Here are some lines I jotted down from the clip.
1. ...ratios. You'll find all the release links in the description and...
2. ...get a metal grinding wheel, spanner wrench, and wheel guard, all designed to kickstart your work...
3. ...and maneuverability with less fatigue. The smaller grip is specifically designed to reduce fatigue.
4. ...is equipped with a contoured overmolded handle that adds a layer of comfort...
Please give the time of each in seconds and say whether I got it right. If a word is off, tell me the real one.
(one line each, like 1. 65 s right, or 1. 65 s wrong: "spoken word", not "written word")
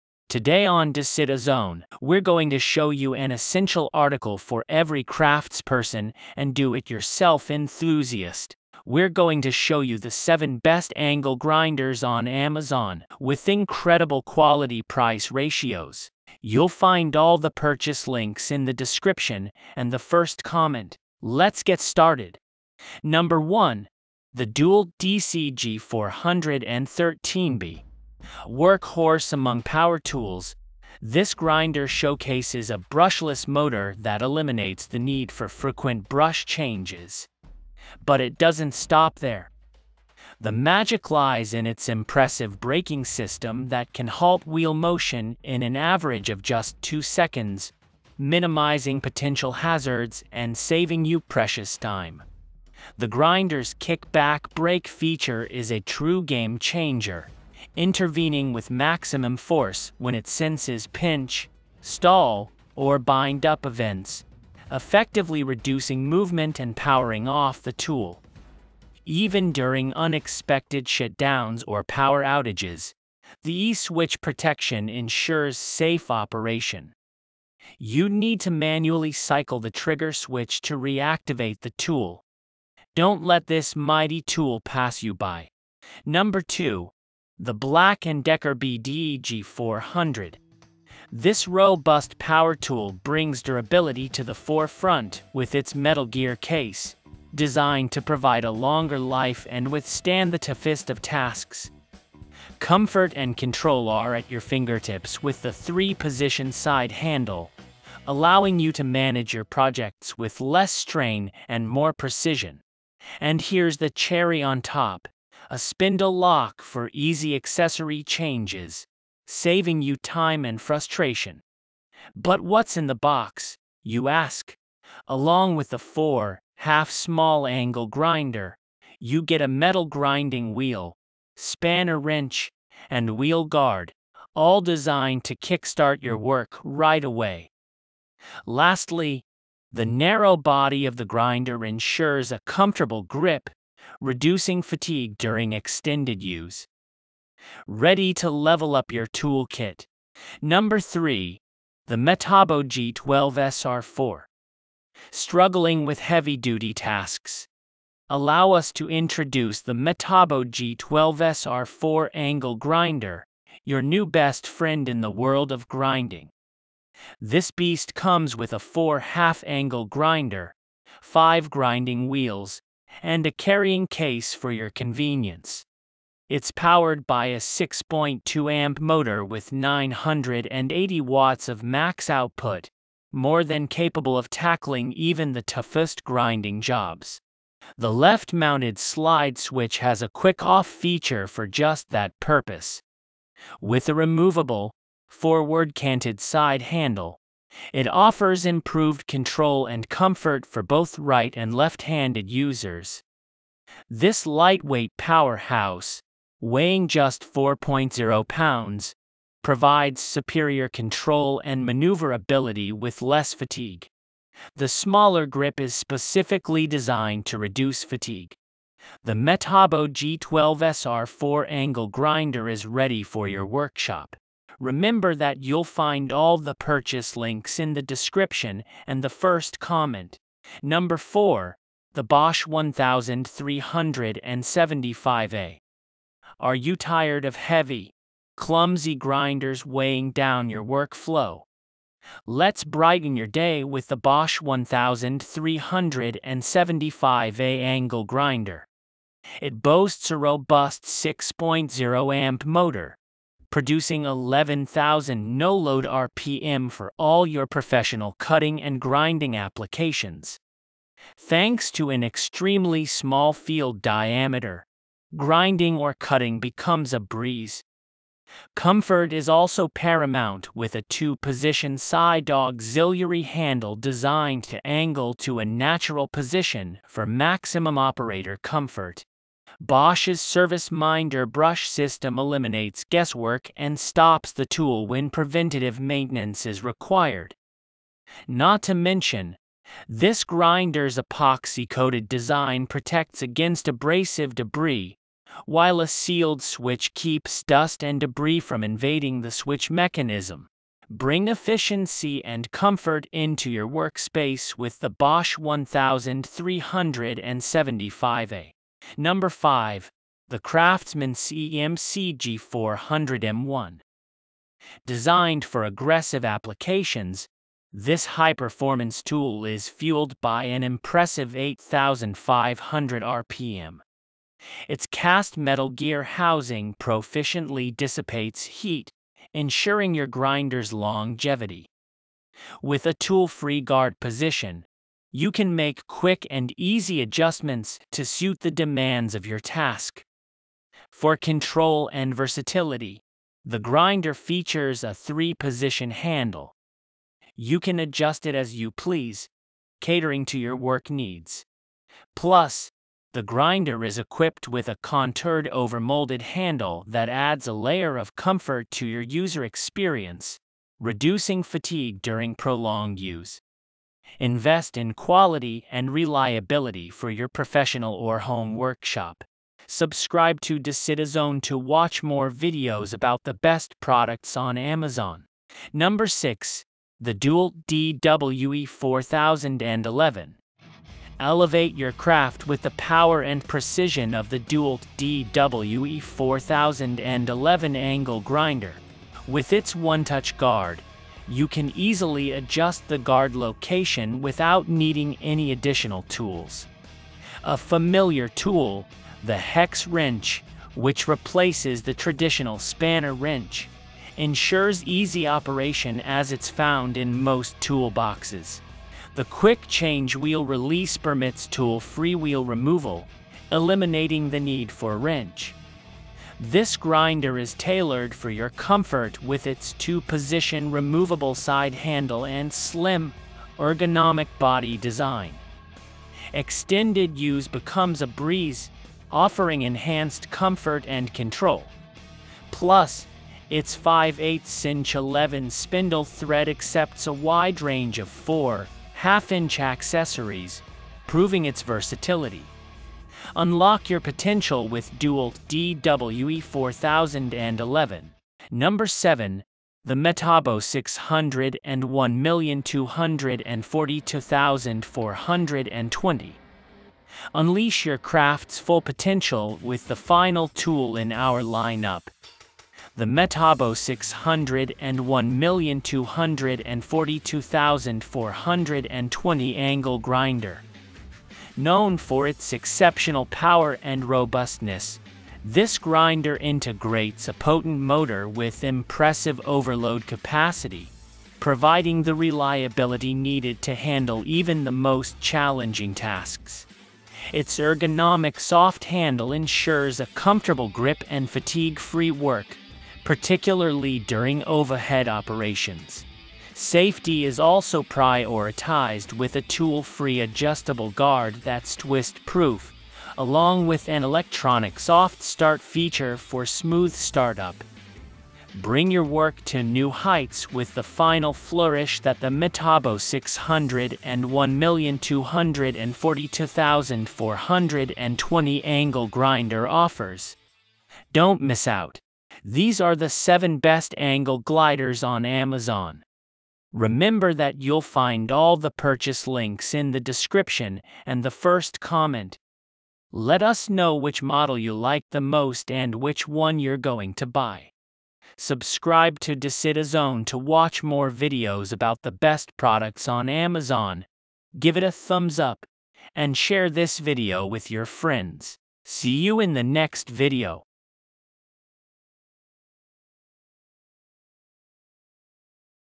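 1. 15 s wrong: "purchase", not "release"
2. 129 s right
3. 211 s right
4. 353 s right.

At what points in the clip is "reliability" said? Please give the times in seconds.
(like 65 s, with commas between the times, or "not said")
365 s, 482 s.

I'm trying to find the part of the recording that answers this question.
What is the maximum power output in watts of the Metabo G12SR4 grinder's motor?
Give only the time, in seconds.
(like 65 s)
179 s.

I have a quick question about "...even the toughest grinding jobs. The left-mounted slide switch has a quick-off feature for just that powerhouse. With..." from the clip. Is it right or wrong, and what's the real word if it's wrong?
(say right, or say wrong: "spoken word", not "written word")
wrong: "purpose", not "powerhouse".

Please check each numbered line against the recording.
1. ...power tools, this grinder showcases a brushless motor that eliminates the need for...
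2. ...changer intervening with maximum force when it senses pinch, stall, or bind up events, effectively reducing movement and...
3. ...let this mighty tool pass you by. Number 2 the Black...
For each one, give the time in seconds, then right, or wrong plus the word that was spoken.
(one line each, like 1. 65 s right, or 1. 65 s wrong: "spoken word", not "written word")
1. 29 s right
2. 56 s right
3. 83 s right.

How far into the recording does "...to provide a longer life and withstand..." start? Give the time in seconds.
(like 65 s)
97 s.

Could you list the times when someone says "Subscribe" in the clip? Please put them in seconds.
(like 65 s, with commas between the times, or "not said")
369 s, 538 s.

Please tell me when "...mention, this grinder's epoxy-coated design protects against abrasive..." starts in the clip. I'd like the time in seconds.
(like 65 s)
288 s.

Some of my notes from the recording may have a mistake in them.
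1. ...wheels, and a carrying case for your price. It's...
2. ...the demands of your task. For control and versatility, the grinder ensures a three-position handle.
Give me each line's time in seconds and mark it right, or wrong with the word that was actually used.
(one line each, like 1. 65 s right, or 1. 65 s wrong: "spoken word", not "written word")
1. 172 s wrong: "convenience", not "price"
2. 338 s wrong: "features", not "ensures".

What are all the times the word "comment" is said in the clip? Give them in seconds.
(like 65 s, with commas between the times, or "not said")
20 s, 229 s, 531 s.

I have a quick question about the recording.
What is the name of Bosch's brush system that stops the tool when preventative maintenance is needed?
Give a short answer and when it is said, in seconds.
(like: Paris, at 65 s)
Service Minder, at 280 s.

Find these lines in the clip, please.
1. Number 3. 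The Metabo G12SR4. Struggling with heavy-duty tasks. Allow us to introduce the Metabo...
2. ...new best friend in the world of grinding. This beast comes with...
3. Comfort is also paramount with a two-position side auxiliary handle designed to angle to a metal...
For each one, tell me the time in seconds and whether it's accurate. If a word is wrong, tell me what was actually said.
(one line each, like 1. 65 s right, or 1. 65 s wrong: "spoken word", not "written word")
1. 150 s right
2. 163 s right
3. 268 s wrong: "natural", not "metal".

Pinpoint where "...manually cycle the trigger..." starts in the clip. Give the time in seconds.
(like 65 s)
78 s.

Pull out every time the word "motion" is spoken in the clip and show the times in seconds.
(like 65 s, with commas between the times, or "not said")
44 s.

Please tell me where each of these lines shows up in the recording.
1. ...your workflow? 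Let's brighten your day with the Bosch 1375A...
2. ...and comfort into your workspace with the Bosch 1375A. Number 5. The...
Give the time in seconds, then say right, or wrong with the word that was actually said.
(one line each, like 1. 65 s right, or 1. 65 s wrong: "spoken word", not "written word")
1. 240 s right
2. 302 s right.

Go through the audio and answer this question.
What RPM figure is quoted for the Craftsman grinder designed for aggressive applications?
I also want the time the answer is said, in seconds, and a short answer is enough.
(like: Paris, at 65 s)
8,500, at 321 s.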